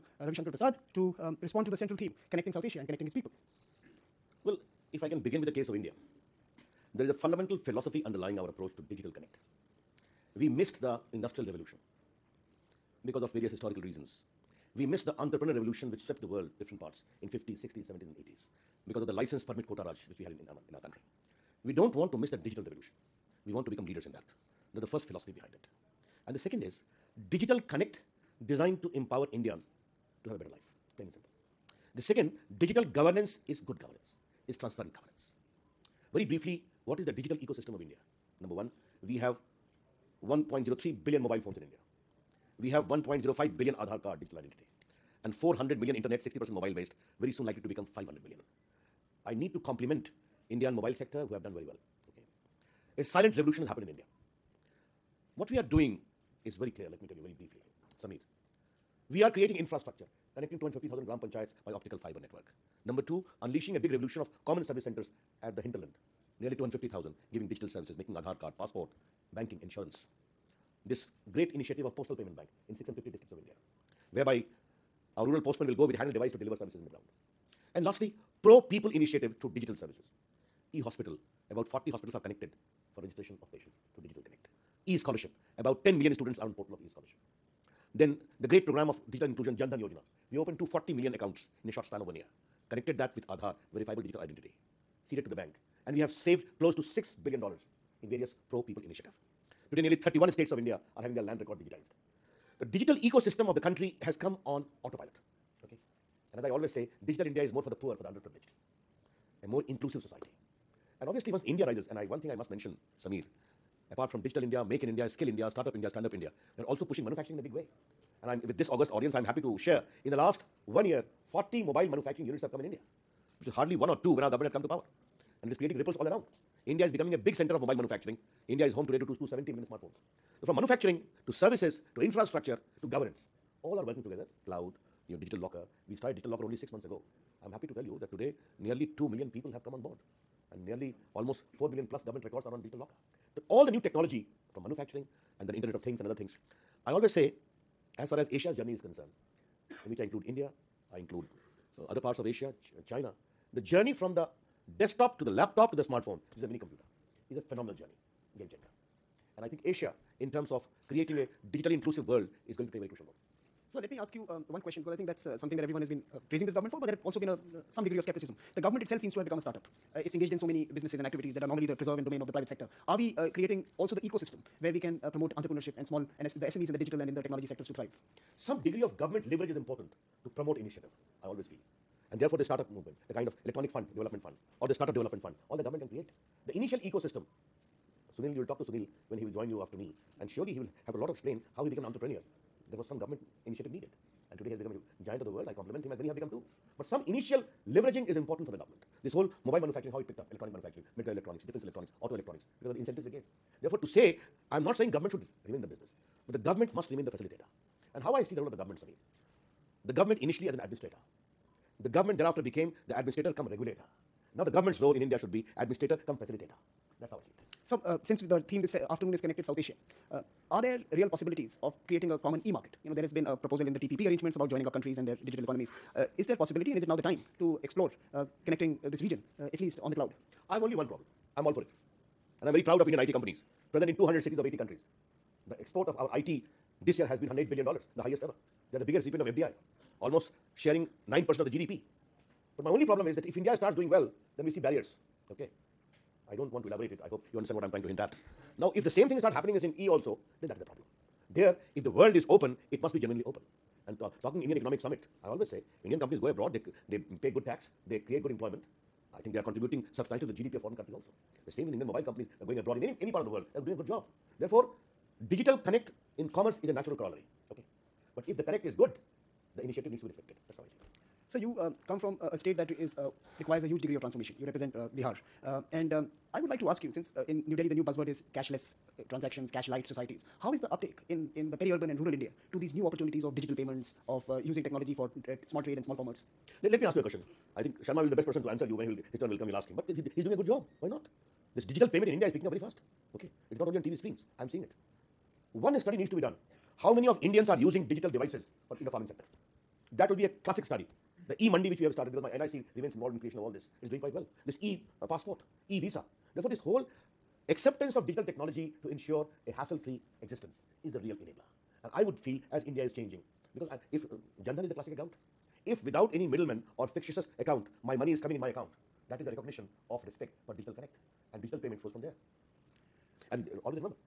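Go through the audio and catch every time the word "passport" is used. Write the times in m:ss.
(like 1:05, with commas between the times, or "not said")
1:08, 5:04.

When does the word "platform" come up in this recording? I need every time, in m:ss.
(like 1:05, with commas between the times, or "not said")
not said.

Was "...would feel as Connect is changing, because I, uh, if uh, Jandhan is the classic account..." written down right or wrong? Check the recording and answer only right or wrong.
wrong.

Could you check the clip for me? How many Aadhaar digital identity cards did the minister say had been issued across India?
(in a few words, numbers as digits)
1.05 billion.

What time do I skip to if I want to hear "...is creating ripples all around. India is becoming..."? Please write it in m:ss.
2:05.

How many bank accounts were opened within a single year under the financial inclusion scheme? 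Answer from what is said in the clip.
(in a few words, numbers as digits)
240 million.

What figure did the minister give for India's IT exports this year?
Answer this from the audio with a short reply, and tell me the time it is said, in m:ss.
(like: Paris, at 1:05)
$108 billion, at 3:57.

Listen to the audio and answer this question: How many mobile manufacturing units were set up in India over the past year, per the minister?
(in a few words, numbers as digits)
40.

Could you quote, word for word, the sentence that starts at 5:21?
And digital payment flows from there.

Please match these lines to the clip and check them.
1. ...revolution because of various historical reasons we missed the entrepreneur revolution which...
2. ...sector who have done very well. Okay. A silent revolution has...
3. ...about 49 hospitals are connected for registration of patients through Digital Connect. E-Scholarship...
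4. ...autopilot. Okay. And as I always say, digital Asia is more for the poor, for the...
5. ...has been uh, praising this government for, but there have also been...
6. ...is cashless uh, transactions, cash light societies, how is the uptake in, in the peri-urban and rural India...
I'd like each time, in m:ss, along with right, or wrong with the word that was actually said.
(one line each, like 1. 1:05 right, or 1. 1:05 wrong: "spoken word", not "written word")
1. 0:11 right
2. 0:50 right
3. 1:21 wrong: "40", not "49"
4. 1:44 wrong: "India", not "Asia"
5. 2:45 right
6. 4:38 right.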